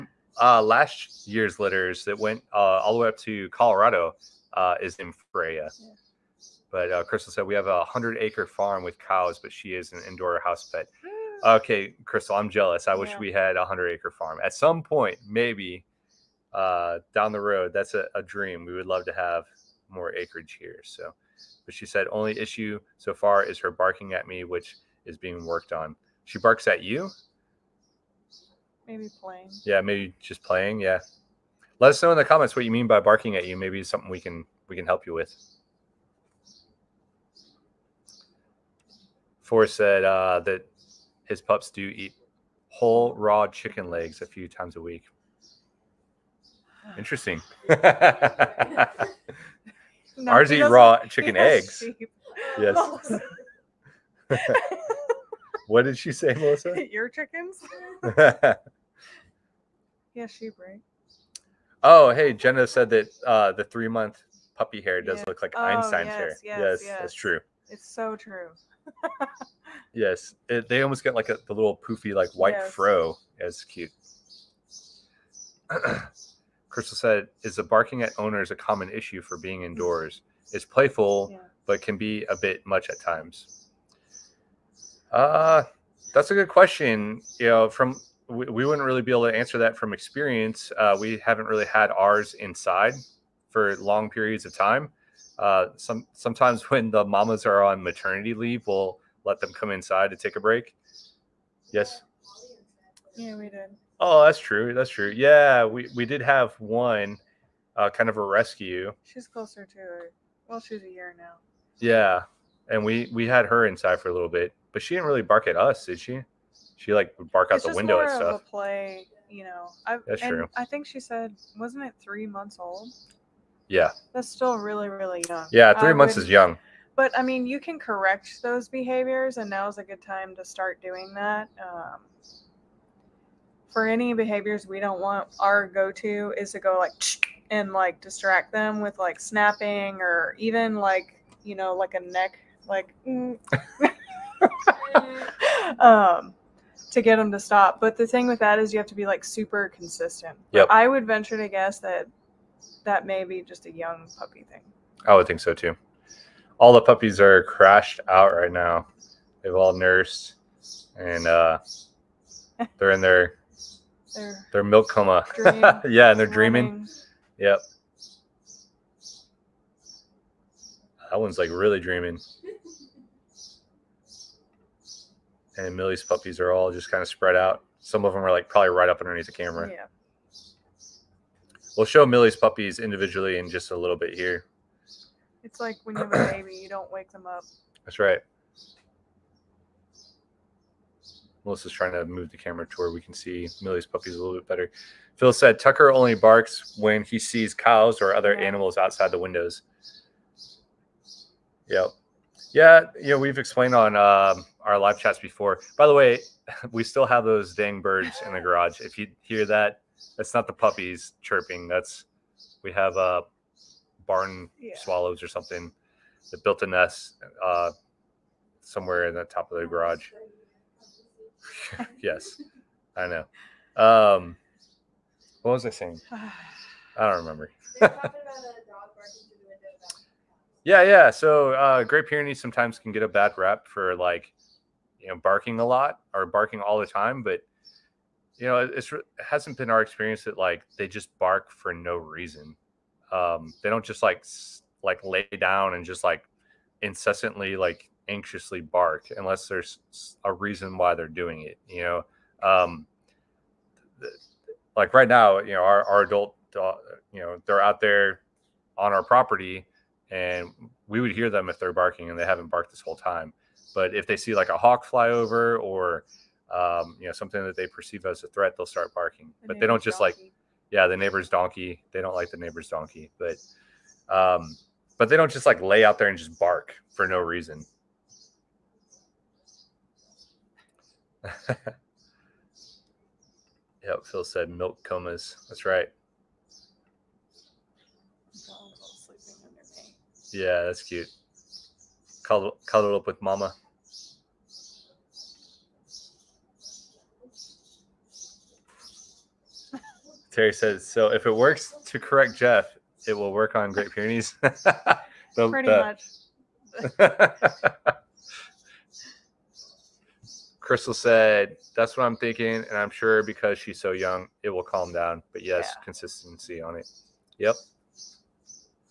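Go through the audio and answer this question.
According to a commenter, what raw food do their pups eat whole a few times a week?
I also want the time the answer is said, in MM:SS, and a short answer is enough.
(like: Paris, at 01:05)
Chicken legs, at 00:42.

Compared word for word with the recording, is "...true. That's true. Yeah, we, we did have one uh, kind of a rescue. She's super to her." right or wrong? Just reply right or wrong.
wrong.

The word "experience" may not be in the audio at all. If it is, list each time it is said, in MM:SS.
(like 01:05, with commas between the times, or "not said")
01:29, 03:59.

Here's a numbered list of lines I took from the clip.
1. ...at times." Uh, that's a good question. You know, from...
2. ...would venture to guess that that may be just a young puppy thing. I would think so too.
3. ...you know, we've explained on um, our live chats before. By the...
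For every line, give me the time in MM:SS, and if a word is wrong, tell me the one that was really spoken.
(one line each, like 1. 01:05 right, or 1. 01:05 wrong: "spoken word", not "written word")
1. 01:22 right
2. 02:30 right
3. 03:23 right.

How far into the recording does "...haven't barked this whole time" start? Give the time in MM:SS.
04:22.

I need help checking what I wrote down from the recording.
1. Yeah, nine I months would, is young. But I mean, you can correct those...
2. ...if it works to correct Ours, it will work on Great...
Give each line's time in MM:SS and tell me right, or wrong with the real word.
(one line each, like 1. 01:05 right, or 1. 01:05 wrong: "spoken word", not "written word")
1. 02:05 wrong: "three", not "nine"
2. 05:01 wrong: "Jeff", not "Ours".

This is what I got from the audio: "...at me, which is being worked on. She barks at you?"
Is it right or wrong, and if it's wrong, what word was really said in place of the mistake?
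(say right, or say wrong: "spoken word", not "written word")
right.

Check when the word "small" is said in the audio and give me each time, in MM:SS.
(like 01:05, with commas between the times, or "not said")
not said.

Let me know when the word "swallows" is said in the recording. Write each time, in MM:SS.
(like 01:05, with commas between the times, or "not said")
03:34.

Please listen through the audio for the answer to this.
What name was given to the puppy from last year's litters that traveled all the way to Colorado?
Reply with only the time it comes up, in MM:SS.
00:05.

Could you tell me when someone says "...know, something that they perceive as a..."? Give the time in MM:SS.
04:27.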